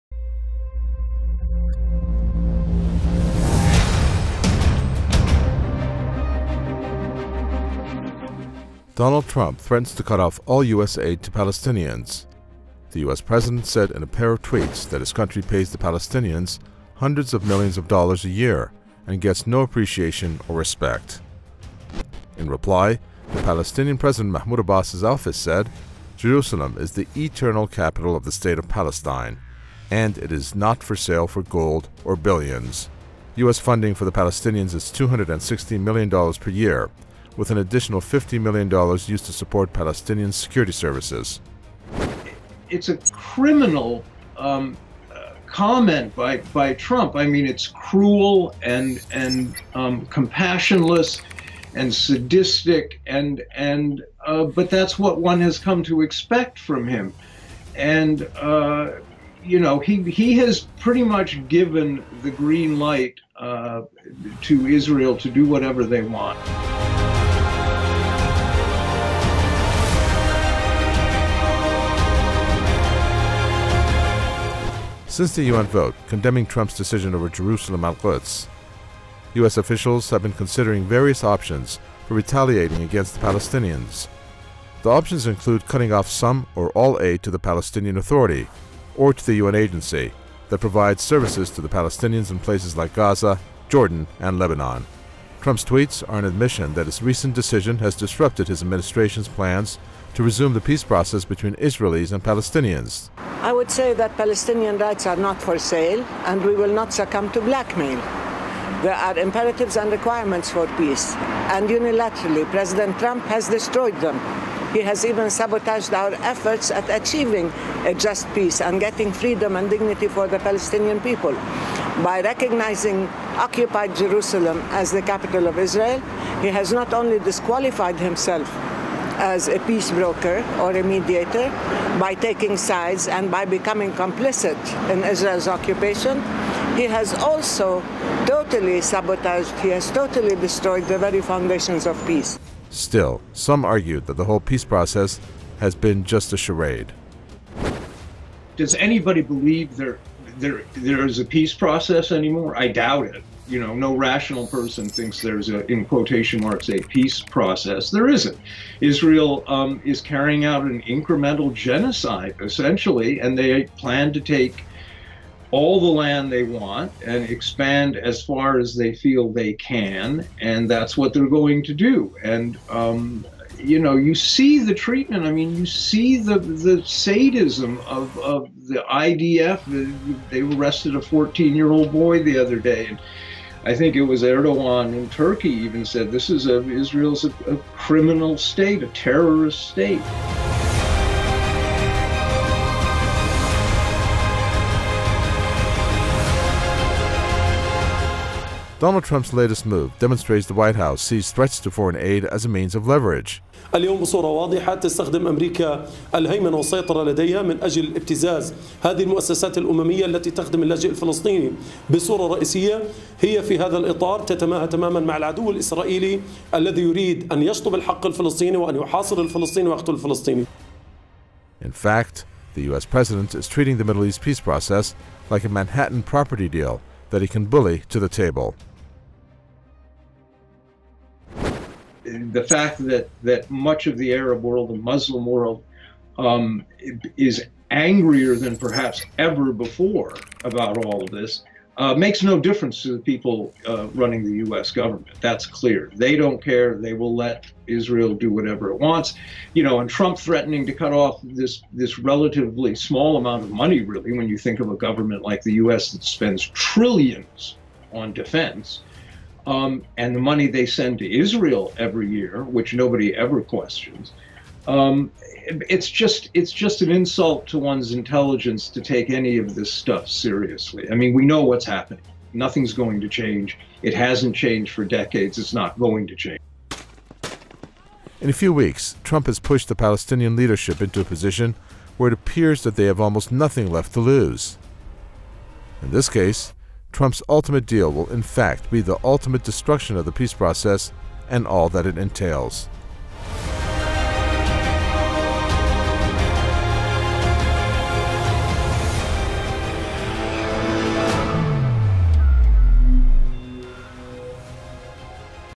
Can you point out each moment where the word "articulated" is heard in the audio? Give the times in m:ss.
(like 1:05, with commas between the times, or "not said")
not said.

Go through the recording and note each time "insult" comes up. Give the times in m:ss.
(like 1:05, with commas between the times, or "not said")
4:26.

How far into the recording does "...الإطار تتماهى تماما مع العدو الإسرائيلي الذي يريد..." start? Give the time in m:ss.
3:33.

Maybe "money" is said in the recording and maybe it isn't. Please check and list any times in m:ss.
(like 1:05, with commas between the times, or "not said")
4:13, 4:20.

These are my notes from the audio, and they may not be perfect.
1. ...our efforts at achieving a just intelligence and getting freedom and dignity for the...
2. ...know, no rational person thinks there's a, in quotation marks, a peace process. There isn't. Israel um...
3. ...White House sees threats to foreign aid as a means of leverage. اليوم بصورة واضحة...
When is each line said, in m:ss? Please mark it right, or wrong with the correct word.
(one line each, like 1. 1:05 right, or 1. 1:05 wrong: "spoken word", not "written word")
1. 1:55 wrong: "peace", not "intelligence"
2. 2:33 right
3. 3:20 right.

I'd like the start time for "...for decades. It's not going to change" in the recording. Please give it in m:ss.
4:34.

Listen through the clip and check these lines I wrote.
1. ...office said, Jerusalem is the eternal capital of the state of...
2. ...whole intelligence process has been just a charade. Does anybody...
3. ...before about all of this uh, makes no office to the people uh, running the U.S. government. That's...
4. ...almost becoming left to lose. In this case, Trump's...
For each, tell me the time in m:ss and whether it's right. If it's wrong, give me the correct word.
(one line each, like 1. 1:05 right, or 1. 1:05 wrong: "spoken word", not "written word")
1. 0:25 right
2. 2:24 wrong: "peace", not "intelligence"
3. 3:59 wrong: "difference", not "office"
4. 4:43 wrong: "nothing", not "becoming".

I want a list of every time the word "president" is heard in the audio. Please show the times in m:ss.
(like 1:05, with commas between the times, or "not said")
0:13, 0:23, 1:52, 3:42.